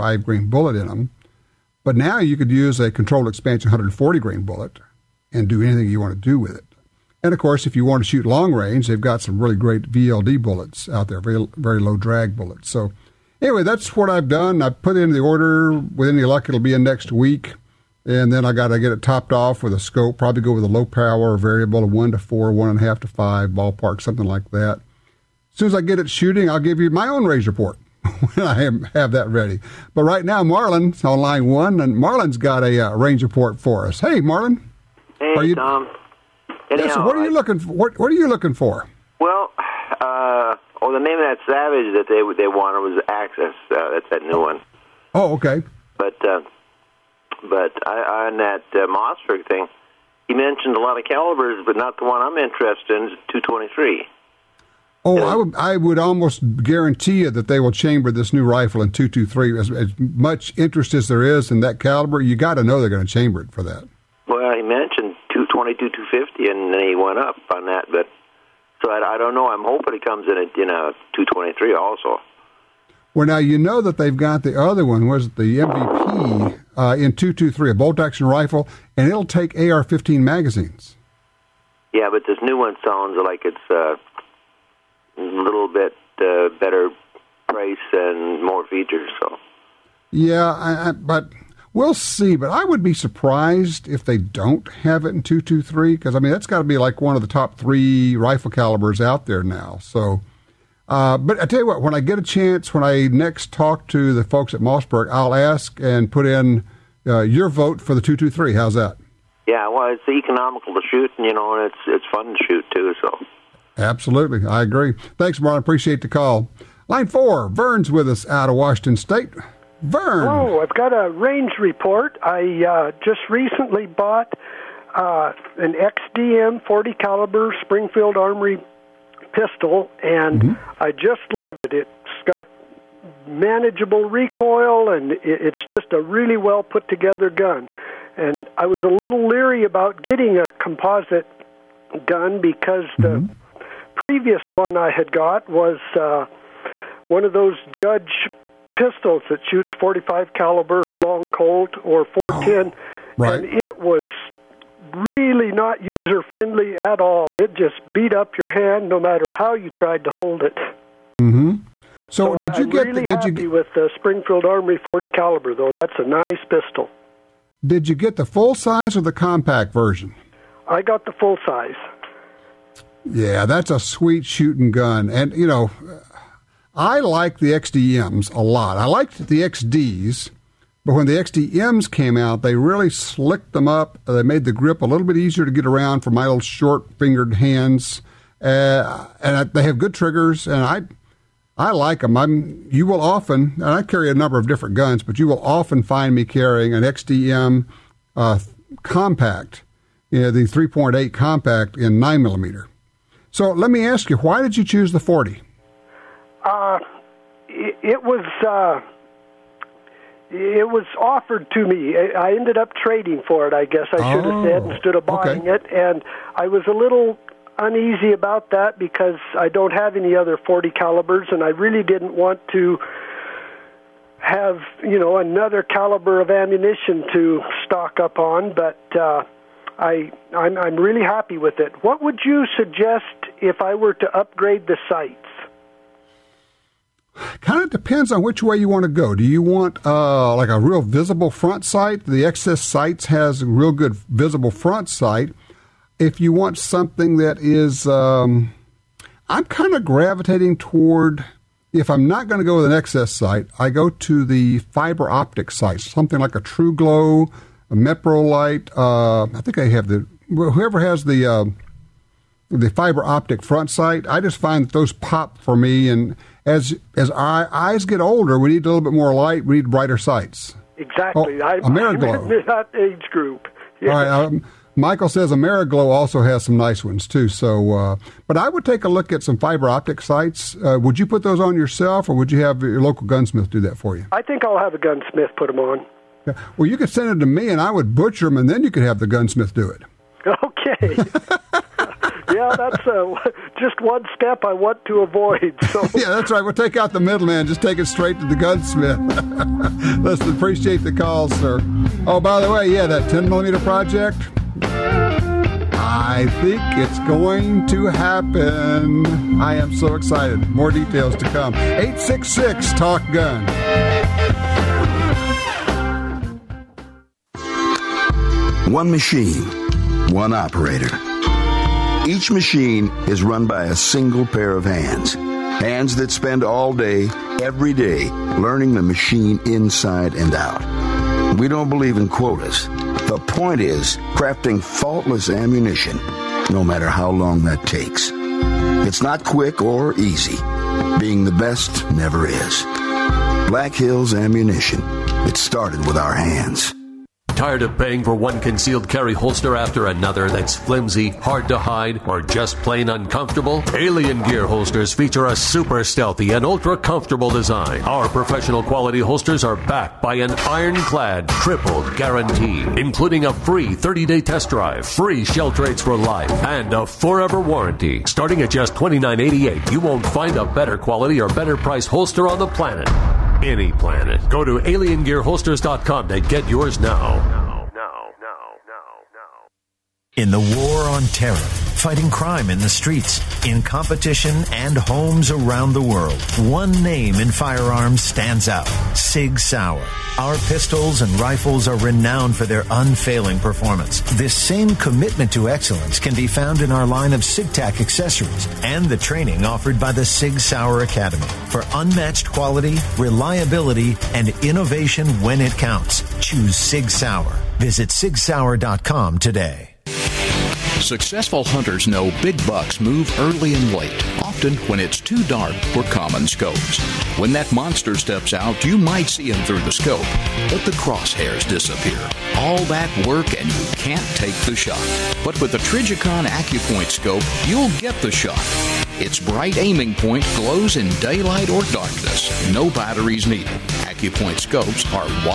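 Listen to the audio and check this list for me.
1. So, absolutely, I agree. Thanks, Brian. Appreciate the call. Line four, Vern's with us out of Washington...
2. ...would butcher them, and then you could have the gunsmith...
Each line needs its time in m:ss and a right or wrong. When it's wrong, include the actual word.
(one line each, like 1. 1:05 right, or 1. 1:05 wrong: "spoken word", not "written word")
1. 1:52 right
2. 4:47 right.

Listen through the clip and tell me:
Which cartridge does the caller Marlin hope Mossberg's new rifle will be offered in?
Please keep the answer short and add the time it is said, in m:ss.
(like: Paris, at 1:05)
223, at 0:53.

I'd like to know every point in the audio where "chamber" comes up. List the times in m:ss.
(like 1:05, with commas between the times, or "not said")
0:57, 1:03.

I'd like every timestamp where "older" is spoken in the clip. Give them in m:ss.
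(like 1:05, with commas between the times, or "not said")
4:27.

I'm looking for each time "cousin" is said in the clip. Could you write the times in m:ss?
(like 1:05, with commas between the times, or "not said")
not said.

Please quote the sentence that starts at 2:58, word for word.
I liked the XDs, but when the XDMs came out, they really slicked them up.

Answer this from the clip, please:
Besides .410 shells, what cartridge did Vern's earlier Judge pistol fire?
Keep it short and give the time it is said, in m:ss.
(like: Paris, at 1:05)
45 long Colt, at 2:29.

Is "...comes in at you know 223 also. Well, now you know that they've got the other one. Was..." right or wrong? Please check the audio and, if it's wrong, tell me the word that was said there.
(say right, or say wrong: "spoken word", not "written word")
right.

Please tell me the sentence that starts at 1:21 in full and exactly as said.
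Yeah, but this new one sounds like it's a uh, little bit uh, better price and more features.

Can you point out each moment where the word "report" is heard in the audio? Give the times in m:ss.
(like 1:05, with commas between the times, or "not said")
0:27, 0:33, 2:01.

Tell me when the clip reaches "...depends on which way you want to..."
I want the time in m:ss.
3:57.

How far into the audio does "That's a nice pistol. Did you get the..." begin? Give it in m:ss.
2:45.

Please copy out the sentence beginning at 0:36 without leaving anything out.
Anyhow, yeah, so what are you I, looking for?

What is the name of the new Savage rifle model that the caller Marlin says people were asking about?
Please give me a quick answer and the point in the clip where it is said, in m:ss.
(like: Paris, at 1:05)
Axis, at 0:43.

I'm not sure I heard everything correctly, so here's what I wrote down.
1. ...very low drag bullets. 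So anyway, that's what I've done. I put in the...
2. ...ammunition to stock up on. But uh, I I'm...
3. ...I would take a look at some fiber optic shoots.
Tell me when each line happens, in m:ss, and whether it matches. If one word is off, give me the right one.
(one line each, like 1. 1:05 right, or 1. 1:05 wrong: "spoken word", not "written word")
1. 0:11 right
2. 3:46 right
3. 4:38 wrong: "sights", not "shoots".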